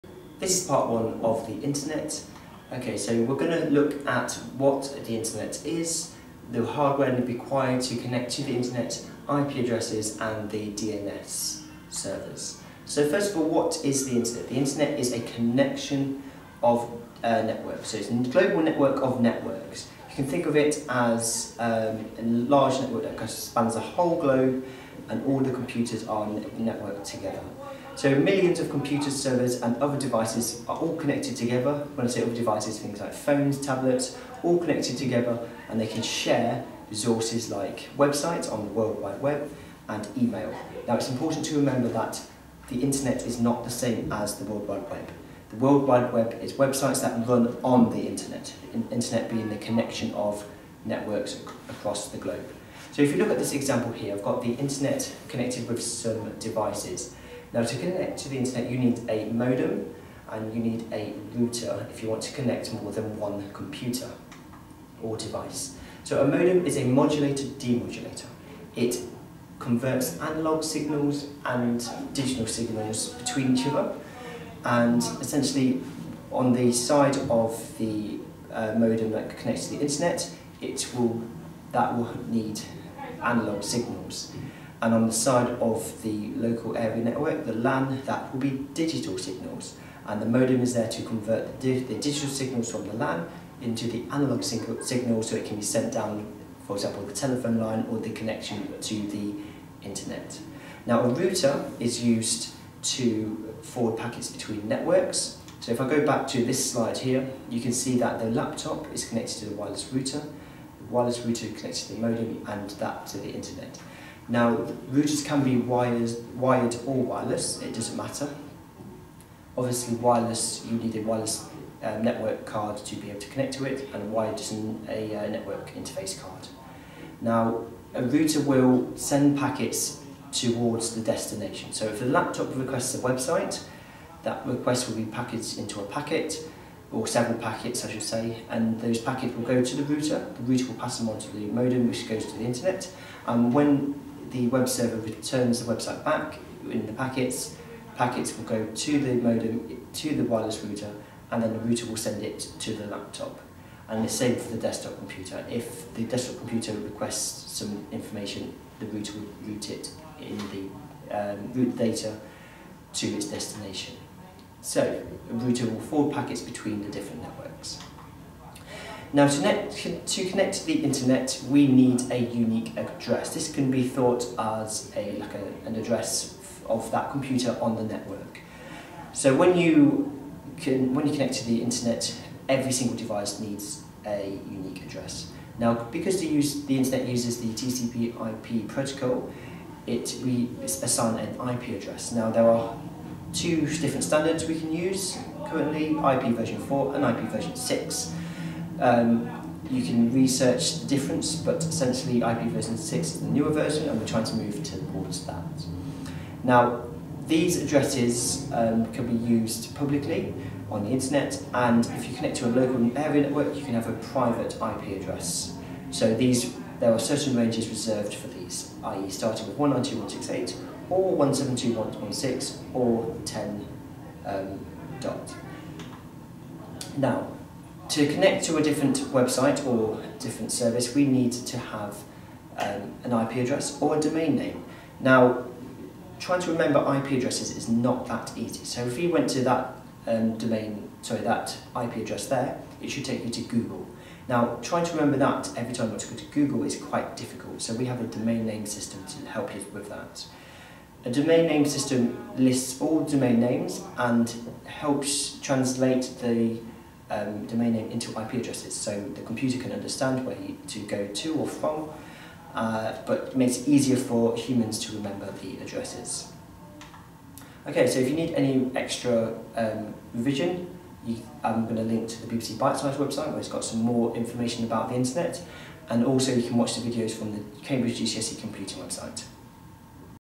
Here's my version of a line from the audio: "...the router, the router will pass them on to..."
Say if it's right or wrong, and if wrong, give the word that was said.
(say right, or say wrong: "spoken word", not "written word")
right.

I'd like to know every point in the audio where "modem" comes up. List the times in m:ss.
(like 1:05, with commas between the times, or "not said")
0:59, 1:06, 1:18, 1:30, 1:51, 2:21, 2:29.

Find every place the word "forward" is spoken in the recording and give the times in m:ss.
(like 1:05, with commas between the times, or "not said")
1:43, 2:45.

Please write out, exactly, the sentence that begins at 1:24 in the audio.
And on the side of the local area network, the LAN, that will be digital signals.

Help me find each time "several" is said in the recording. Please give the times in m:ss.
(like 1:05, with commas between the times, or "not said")
2:17.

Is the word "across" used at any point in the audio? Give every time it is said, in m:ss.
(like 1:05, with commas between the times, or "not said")
0:51.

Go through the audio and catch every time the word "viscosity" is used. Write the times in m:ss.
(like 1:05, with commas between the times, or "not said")
not said.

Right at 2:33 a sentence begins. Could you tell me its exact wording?
and it's same for the desktop computer.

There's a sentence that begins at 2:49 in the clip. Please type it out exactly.
Now to, net, to connect to the internet we need a unique address.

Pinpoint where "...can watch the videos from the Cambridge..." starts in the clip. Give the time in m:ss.
4:36.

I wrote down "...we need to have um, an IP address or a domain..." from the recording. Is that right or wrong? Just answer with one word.
right.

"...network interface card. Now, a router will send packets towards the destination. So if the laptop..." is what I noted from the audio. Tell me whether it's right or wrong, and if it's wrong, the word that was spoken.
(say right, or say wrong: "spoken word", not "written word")
right.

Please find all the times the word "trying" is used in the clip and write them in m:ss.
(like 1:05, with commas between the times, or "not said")
3:24, 3:56, 4:04.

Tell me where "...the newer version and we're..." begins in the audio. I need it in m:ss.
3:23.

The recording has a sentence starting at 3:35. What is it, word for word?
So these, there are certain ranges reserved for these, i.e.